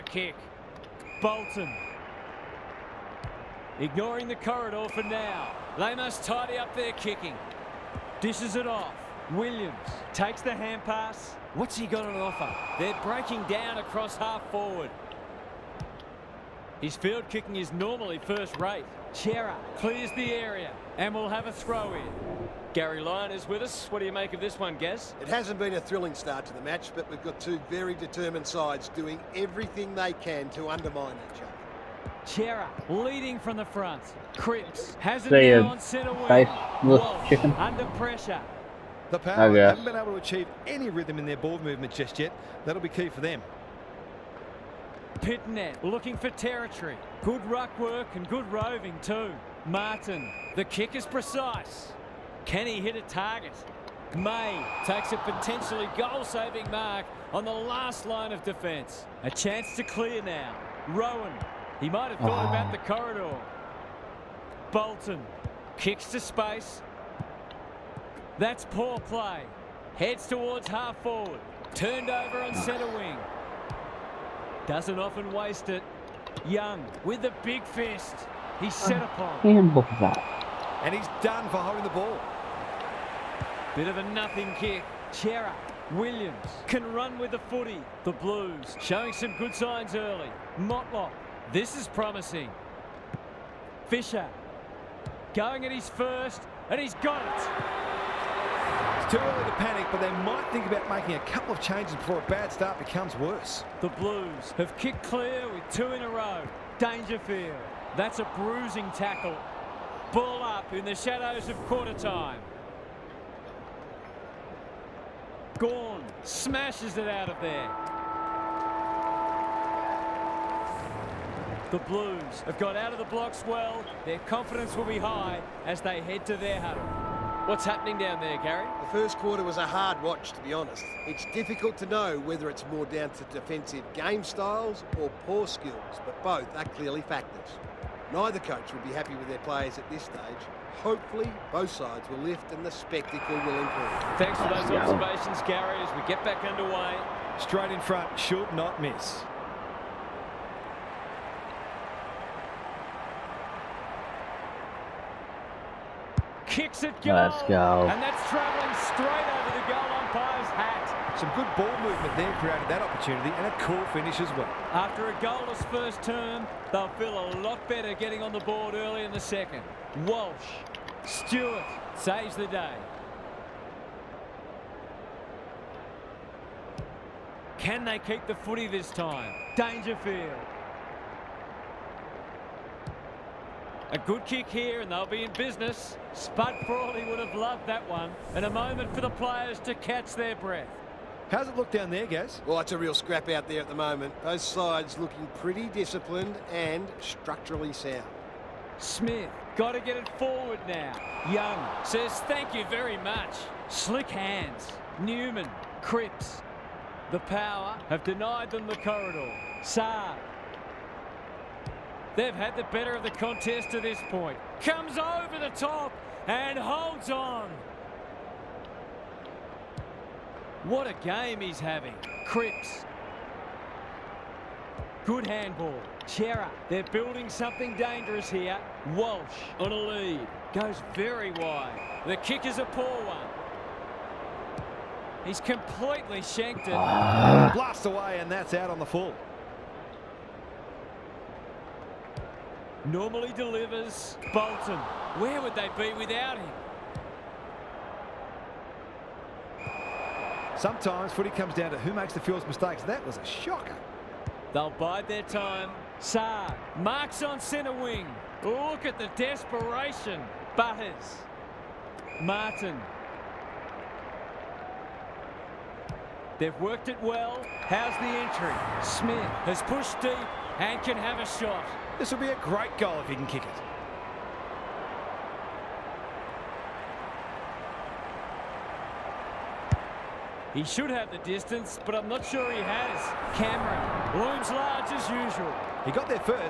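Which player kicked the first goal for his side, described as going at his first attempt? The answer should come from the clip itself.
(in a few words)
Fisher.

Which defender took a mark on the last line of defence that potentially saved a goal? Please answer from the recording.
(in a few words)
May.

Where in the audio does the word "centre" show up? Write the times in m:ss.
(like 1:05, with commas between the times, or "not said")
0:35, 1:12, 4:17.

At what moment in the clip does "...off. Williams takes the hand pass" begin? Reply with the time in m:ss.
0:08.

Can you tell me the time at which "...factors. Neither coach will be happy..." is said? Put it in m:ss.
2:17.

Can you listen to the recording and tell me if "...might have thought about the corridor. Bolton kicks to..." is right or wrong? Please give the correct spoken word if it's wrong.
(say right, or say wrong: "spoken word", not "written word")
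right.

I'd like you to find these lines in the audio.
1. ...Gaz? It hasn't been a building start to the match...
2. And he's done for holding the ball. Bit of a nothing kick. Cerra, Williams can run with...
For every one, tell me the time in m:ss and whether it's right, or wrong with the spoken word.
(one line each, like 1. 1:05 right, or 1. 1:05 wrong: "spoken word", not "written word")
1. 0:24 wrong: "thrilling", not "building"
2. 1:20 right.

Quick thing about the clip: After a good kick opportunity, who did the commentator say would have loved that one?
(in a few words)
Spud Brawley.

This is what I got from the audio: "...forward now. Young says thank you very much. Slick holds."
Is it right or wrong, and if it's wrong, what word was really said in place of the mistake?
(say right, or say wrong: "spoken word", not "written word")
wrong: "hands", not "holds".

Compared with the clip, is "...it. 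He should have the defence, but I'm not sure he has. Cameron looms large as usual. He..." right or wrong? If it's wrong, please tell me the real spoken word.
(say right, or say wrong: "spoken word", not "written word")
wrong: "distance", not "defence".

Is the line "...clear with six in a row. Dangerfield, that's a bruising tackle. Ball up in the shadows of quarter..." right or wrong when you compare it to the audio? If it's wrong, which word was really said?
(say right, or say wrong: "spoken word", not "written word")
wrong: "two", not "six".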